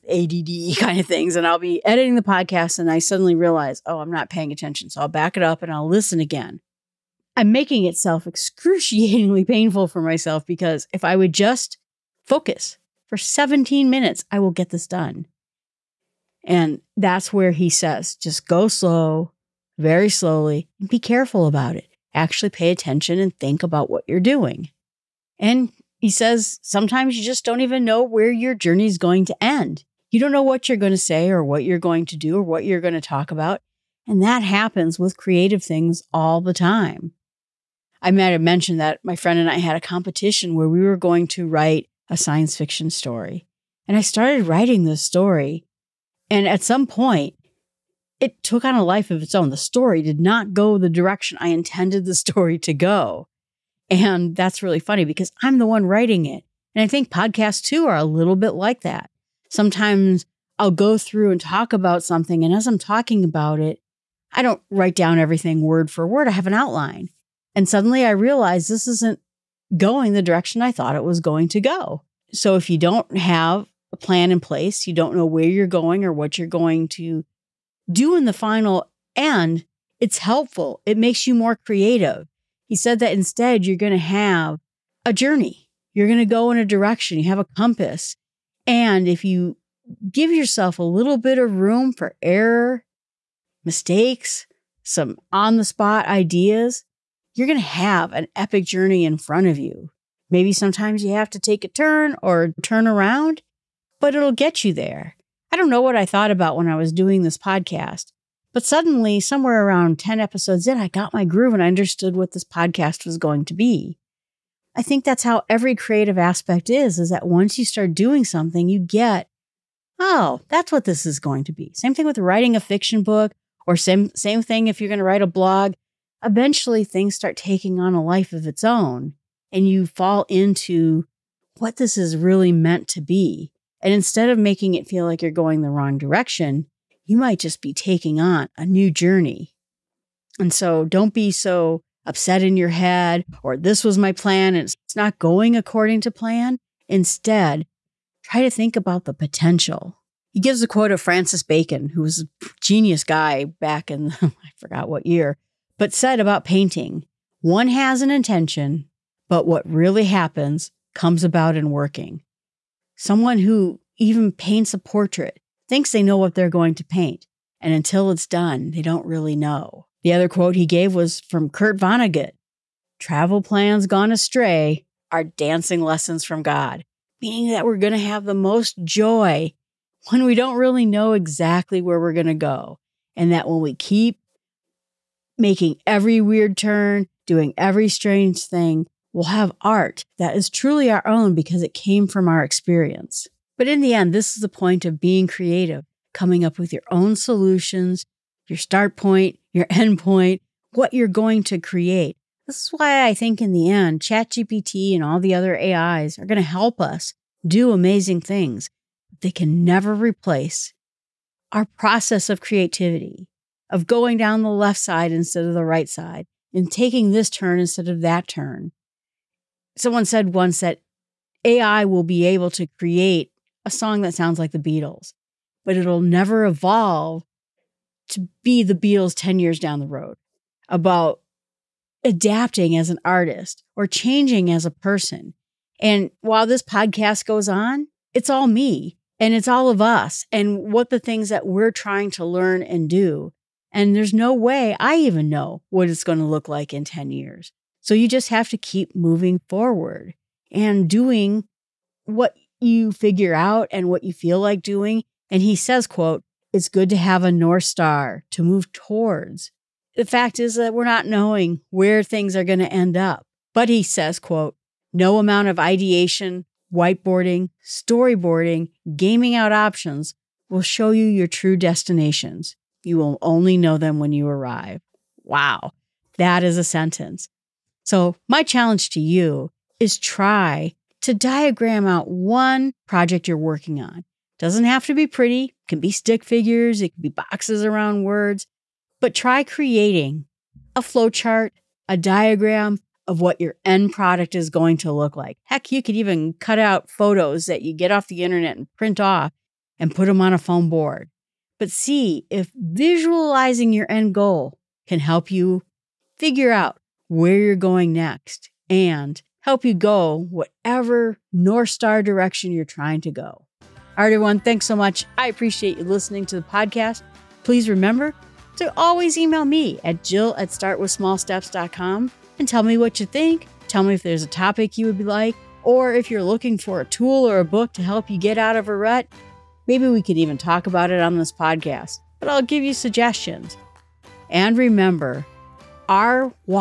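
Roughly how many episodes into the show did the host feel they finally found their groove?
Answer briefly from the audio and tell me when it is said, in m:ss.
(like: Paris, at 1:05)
10, at 1:49.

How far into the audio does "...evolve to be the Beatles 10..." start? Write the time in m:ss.
3:46.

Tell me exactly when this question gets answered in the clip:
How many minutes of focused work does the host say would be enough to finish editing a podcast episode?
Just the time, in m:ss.
0:13.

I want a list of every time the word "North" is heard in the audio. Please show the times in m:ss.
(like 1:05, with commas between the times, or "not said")
4:17, 5:11.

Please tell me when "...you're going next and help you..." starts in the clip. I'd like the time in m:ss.
5:07.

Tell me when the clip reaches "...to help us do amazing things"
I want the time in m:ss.
3:26.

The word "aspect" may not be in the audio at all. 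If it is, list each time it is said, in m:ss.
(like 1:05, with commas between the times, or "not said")
1:56.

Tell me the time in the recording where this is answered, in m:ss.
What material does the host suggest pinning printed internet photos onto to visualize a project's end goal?
5:00.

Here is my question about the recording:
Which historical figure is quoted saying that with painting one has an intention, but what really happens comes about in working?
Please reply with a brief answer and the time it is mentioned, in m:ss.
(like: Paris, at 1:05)
Francis Bacon, at 2:31.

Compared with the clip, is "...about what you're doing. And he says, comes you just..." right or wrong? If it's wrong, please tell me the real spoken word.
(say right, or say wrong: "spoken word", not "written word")
wrong: "sometimes", not "comes".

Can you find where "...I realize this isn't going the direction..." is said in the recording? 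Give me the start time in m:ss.
1:08.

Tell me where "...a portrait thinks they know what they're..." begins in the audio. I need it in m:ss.
2:44.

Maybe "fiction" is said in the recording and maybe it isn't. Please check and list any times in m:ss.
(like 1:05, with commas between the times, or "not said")
0:42, 2:02.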